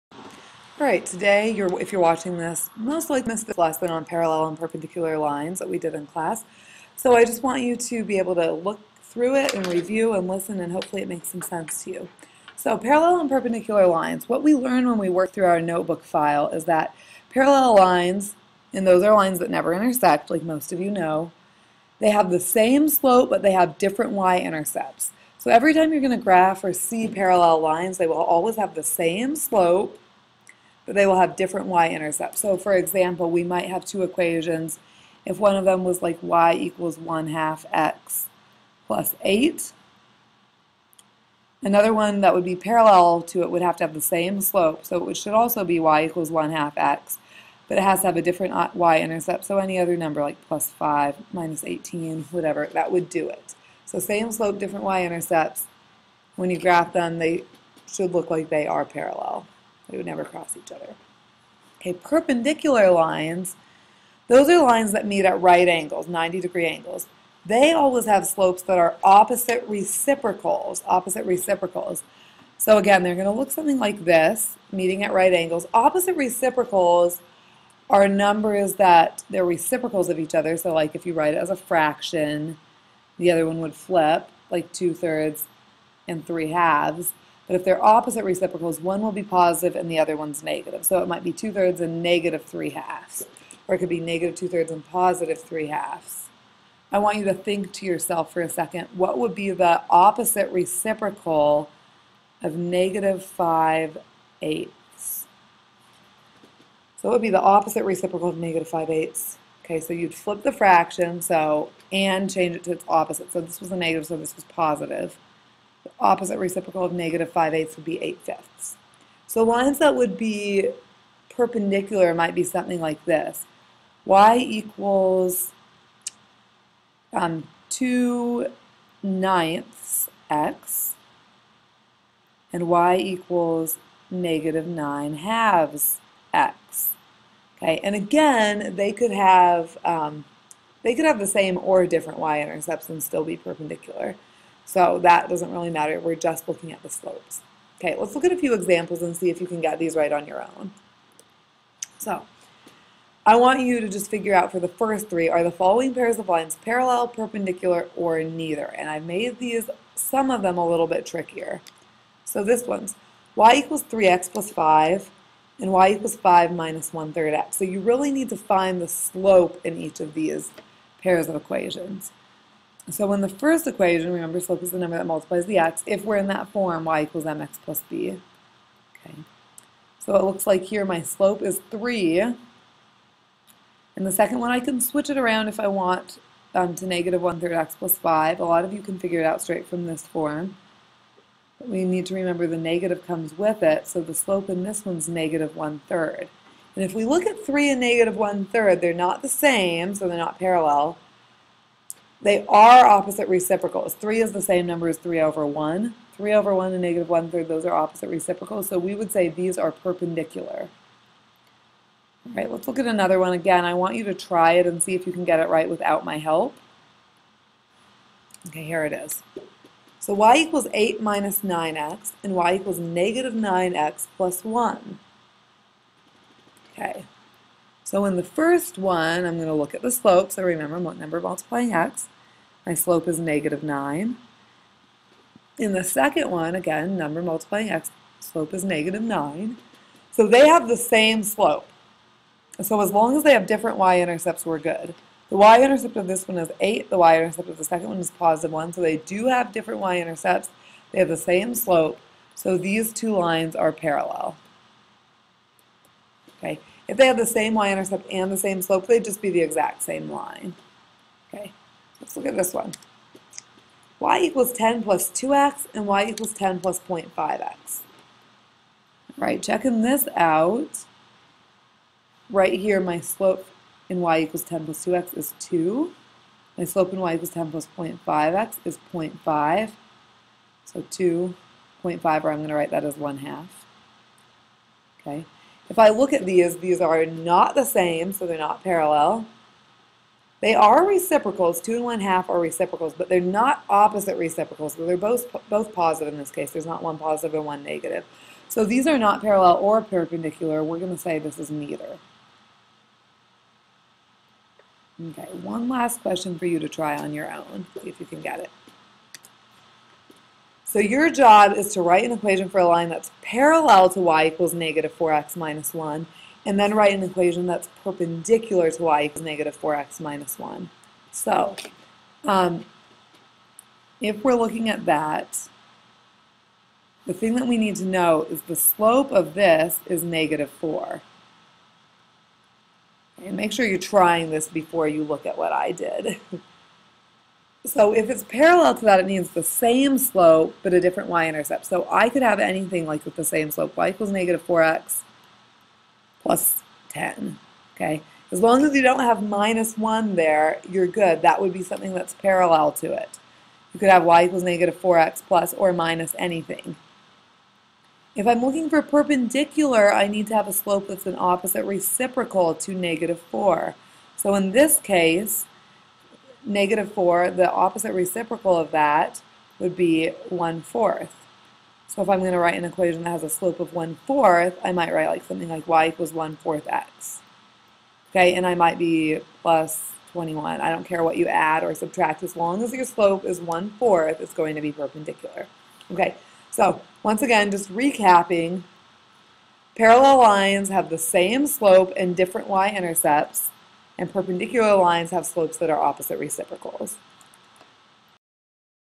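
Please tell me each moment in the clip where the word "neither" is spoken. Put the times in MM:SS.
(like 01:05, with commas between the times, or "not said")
02:38, 05:01.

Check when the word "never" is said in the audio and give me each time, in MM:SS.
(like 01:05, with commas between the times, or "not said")
00:19, 01:00.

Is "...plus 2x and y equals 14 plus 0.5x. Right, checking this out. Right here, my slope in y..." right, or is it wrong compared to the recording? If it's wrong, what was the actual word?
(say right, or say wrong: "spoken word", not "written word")
wrong: "10", not "14".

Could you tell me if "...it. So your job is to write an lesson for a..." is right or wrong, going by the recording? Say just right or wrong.
wrong.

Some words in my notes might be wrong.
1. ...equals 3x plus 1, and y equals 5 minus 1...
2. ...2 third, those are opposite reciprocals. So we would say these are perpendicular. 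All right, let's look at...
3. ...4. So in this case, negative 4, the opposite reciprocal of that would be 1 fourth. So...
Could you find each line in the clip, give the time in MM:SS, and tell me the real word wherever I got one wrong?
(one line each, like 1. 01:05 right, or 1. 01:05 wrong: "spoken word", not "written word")
1. 02:43 wrong: "5", not "1"
2. 03:27 wrong: "1", not "2"
3. 06:03 right.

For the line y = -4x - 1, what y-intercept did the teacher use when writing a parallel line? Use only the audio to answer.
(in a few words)
10.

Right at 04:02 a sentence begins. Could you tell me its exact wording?
So as long as they have different y-intercepts, we're good.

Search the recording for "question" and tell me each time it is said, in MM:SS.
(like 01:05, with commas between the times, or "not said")
05:06.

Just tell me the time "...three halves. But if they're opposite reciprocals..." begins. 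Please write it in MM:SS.
01:26.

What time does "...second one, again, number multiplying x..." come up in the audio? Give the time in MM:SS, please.
03:55.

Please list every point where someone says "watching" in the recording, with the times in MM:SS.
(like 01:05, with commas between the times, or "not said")
00:02.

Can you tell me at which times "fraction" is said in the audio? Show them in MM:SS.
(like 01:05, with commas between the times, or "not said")
01:21, 01:50.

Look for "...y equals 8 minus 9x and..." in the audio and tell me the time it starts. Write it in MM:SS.
03:40.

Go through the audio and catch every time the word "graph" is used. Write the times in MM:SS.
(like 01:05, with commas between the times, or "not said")
00:26, 00:56.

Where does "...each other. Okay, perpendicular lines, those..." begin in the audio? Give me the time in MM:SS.
01:00.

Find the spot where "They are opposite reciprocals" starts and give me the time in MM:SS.
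03:22.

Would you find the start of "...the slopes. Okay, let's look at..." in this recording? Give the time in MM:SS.
02:26.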